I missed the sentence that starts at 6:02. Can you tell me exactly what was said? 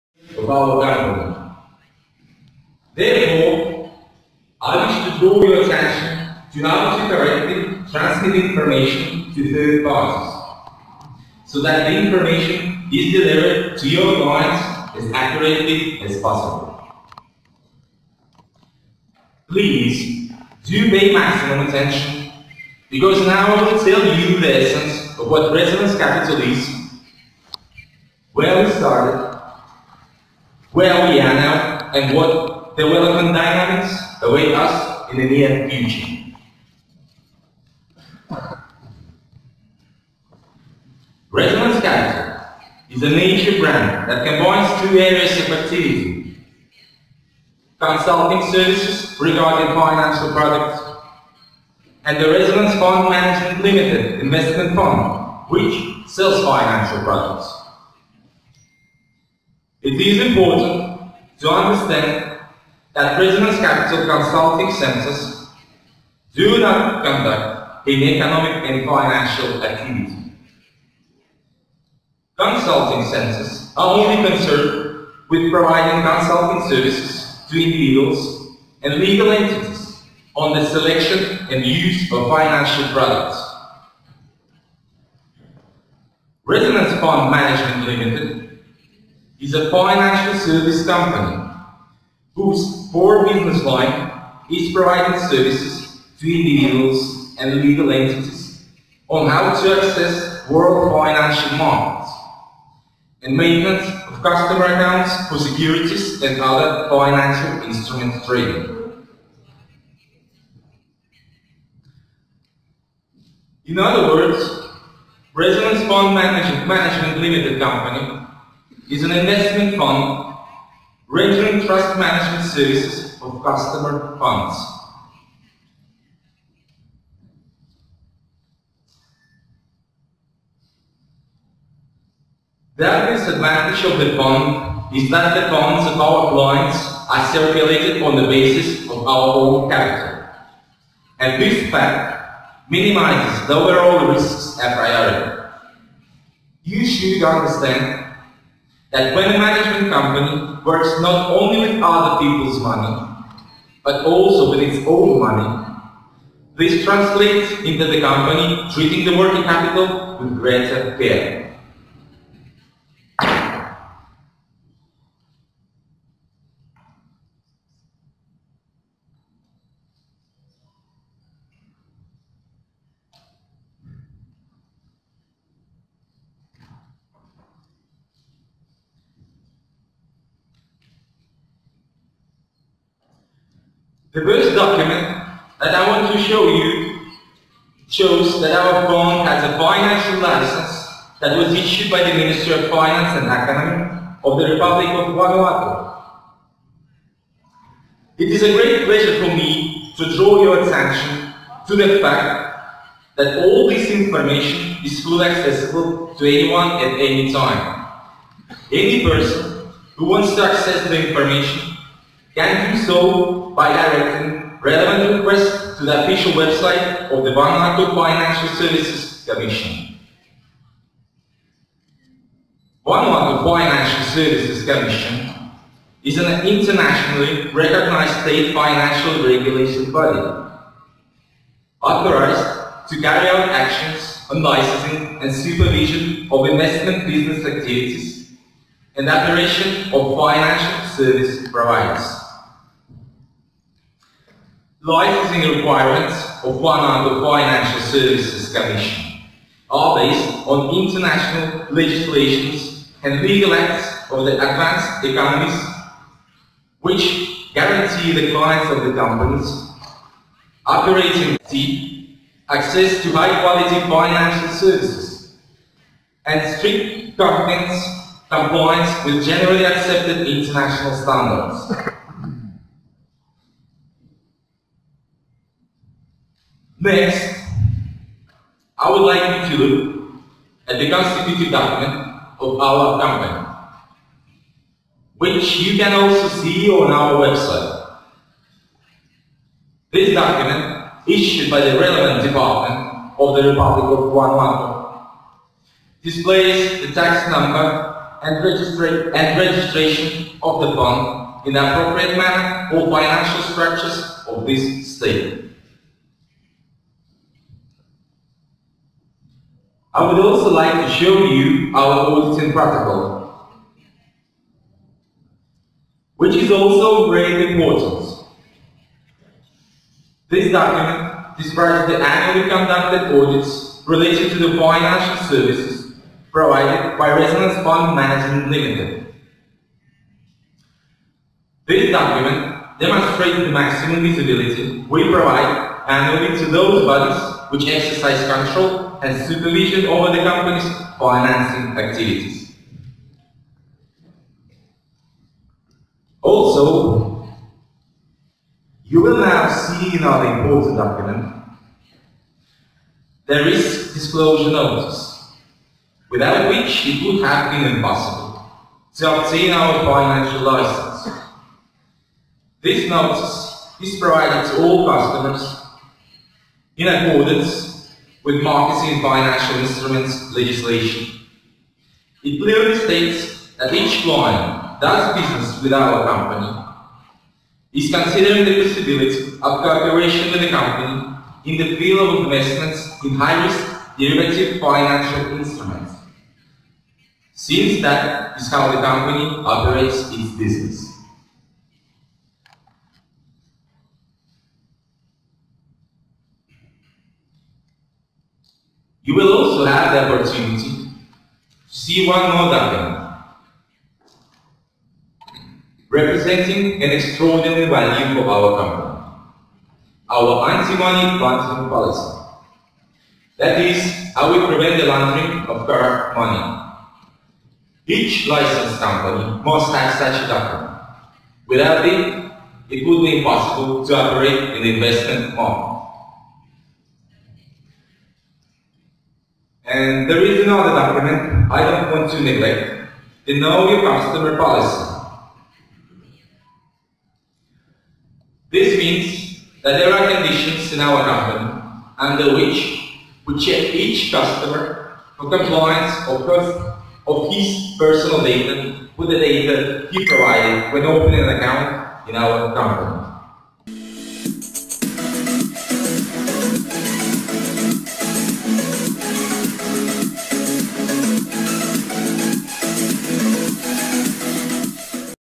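This notice is provided to all customers in accordance with marketing financial instruments legislation.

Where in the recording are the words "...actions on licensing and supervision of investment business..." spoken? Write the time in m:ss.
3:53.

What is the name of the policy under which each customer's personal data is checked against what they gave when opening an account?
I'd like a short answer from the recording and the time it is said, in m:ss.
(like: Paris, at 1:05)
Know Your Customer Policy, at 7:13.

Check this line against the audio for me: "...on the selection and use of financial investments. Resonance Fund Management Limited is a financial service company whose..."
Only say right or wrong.
wrong.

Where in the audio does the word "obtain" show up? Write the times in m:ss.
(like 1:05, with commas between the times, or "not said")
5:59.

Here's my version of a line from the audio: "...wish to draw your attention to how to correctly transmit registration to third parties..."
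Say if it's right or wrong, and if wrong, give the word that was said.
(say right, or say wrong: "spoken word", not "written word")
wrong: "information", not "registration".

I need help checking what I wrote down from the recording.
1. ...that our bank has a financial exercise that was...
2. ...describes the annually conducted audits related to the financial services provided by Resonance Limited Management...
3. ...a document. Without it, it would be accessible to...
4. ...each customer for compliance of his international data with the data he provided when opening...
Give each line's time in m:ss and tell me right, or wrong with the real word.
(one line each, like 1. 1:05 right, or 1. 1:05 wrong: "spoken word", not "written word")
1. 3:08 wrong: "license", not "exercise"
2. 5:21 wrong: "Fund", not "Limited"
3. 7:00 wrong: "impossible", not "accessible"
4. 7:23 wrong: "personal", not "international".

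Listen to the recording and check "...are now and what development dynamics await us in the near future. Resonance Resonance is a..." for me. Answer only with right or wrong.
wrong.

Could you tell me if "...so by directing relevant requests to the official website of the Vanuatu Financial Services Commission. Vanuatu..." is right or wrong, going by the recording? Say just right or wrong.
right.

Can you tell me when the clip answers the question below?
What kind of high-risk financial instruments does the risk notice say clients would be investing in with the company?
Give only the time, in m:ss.
6:23.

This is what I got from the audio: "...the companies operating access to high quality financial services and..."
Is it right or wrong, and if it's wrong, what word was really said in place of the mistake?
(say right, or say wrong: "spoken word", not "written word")
right.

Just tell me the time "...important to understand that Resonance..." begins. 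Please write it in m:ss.
1:00.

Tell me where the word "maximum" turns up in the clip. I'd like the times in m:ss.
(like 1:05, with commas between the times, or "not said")
0:21, 5:33.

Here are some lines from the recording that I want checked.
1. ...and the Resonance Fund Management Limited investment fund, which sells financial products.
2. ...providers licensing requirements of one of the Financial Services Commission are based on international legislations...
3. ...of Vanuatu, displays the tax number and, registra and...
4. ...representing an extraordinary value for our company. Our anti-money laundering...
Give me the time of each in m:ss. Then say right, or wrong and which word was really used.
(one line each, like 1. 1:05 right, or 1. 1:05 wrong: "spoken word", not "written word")
1. 0:52 right
2. 4:01 right
3. 4:53 right
4. 6:45 right.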